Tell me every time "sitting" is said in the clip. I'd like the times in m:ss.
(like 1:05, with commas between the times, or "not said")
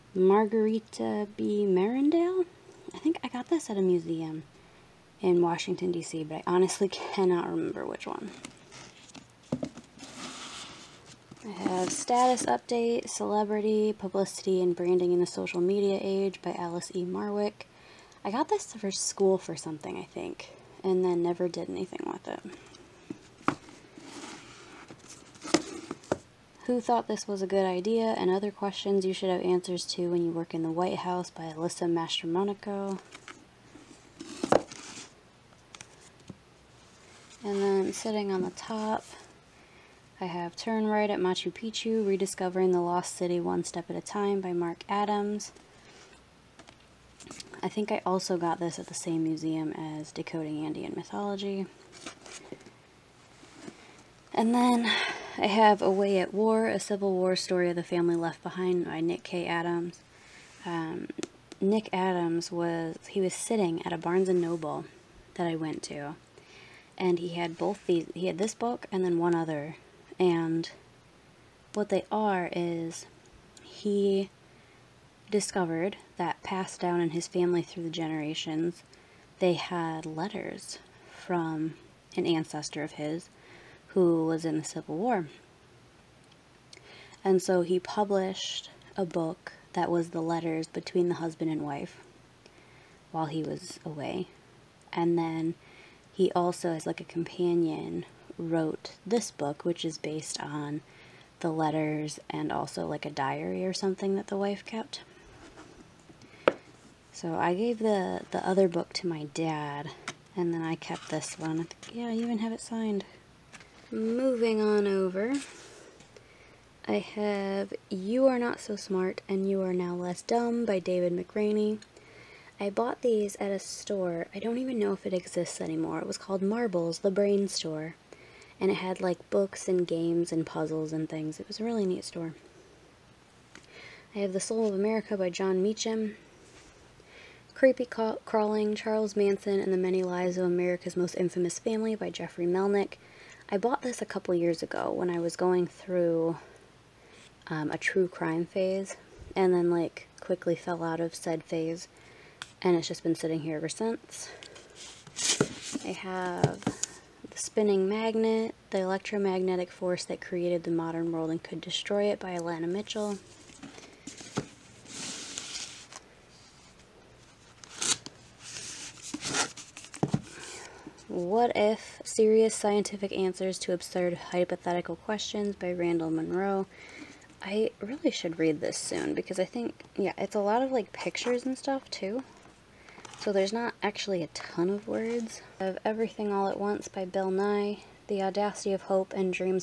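0:37, 1:03, 2:33.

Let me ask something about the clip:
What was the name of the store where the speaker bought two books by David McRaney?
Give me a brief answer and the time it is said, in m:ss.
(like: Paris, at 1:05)
Marbles, the Brain Store, at 2:06.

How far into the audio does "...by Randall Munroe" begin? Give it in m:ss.
2:55.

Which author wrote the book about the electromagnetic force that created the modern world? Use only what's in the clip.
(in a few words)
Alanna Mitchell.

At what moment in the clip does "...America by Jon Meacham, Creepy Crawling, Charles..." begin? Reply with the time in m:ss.
2:14.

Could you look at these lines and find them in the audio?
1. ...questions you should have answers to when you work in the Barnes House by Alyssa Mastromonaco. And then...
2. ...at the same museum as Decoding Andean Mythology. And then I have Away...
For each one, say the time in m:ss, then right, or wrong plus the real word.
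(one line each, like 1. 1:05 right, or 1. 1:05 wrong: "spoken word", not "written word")
1. 0:28 wrong: "White", not "Barnes"
2. 0:48 right.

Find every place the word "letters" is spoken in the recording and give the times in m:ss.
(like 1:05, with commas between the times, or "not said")
1:20, 1:30, 1:41.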